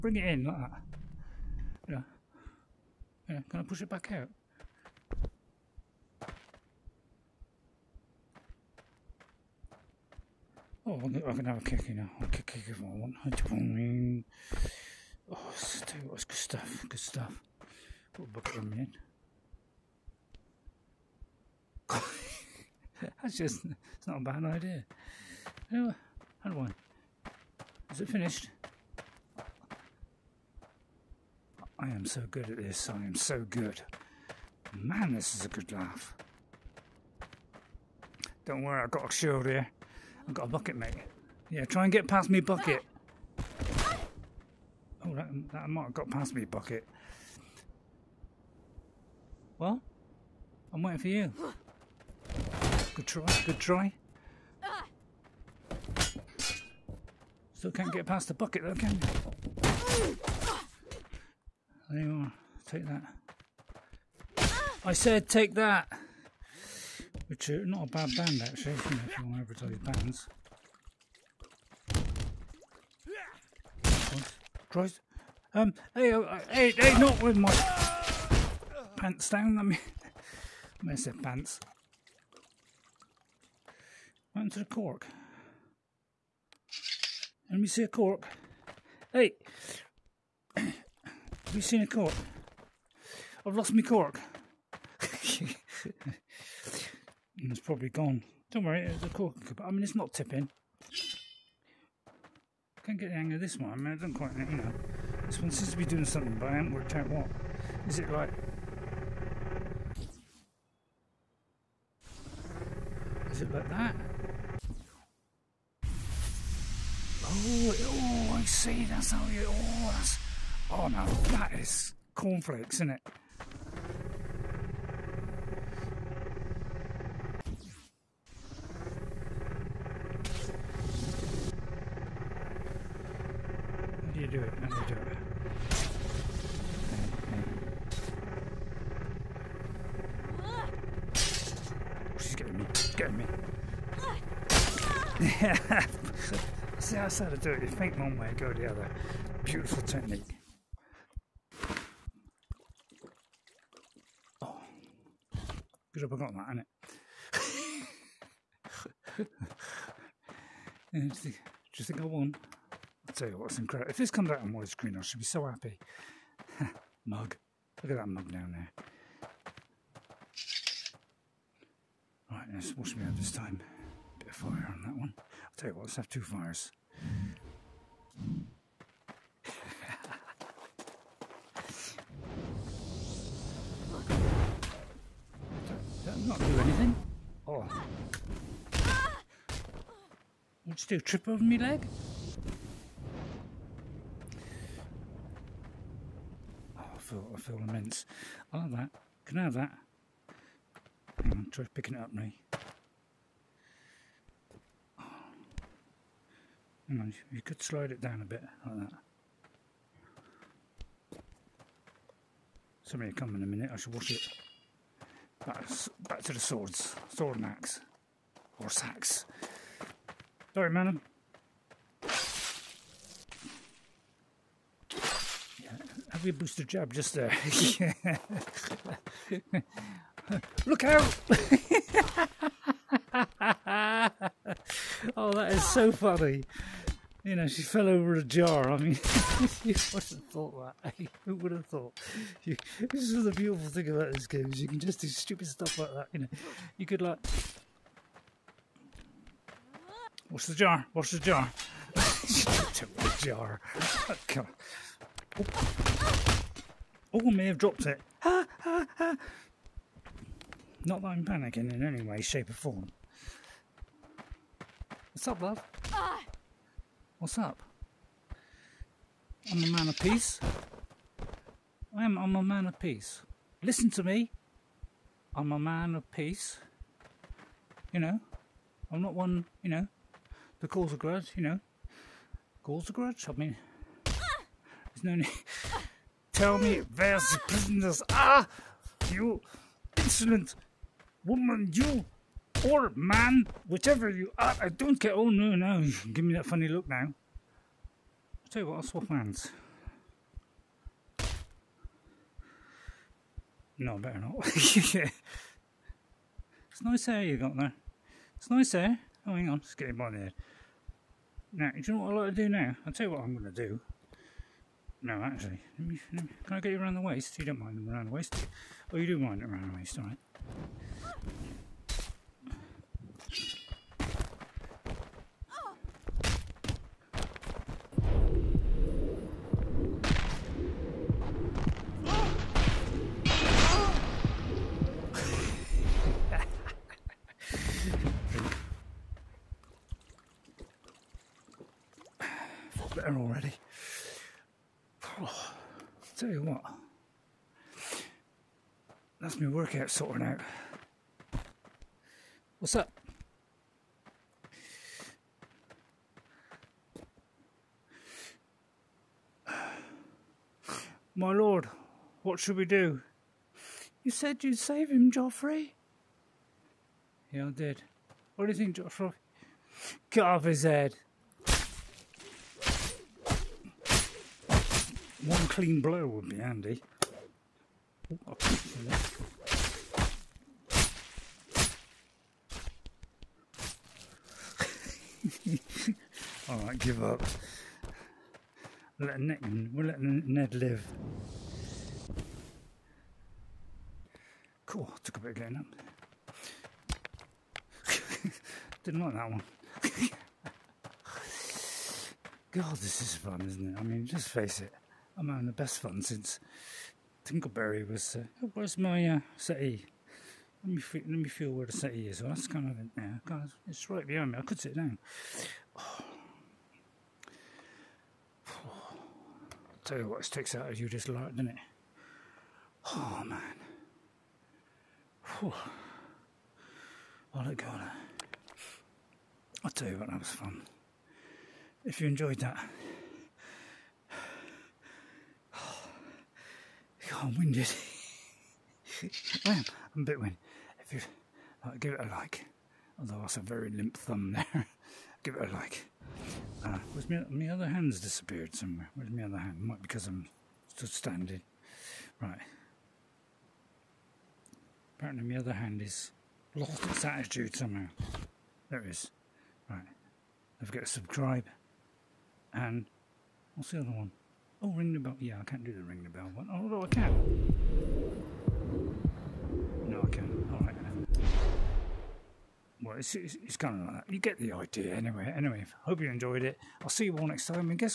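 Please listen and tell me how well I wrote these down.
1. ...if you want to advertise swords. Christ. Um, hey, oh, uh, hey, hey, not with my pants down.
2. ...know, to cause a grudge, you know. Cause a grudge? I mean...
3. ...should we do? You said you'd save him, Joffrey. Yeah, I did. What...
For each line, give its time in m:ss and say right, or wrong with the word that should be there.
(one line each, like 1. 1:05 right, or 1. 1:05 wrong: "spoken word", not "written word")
1. 1:09 wrong: "bands", not "swords"
2. 4:39 right
3. 6:02 right.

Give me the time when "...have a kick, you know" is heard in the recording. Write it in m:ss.
0:11.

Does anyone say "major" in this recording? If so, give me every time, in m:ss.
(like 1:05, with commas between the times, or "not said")
not said.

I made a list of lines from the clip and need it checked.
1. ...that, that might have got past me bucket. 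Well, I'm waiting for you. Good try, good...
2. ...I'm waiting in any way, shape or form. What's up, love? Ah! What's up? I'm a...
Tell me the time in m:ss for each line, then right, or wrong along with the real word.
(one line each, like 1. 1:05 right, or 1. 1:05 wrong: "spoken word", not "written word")
1. 0:45 right
2. 4:21 wrong: "panicking", not "waiting".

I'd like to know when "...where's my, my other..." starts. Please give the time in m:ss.
7:26.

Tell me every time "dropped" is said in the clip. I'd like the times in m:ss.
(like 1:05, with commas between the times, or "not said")
4:12, 4:17.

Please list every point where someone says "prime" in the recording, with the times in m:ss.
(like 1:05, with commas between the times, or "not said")
not said.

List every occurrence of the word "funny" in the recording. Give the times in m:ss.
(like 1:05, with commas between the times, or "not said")
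3:55, 4:56.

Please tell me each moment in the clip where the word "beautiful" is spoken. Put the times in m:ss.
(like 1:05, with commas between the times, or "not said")
2:29, 4:03.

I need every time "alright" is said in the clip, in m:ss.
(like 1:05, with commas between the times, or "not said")
5:19.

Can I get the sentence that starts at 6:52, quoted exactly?
Well, that's kind of it now.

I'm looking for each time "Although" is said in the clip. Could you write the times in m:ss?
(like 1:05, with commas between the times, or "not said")
7:22, 7:46.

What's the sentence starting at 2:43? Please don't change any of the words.
If this comes out on widescreen, I should be so happy.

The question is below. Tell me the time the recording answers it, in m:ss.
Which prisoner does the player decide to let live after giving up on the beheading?
6:30.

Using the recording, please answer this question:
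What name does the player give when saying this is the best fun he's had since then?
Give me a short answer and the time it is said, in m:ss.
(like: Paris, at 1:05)
Tinkleberry, at 6:47.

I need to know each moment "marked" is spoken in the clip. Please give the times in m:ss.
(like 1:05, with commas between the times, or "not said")
not said.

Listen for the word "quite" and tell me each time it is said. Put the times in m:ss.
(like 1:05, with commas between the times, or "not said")
1:44.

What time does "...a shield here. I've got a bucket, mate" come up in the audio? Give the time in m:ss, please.
0:39.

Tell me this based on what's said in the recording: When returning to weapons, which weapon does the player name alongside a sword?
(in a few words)
Axe.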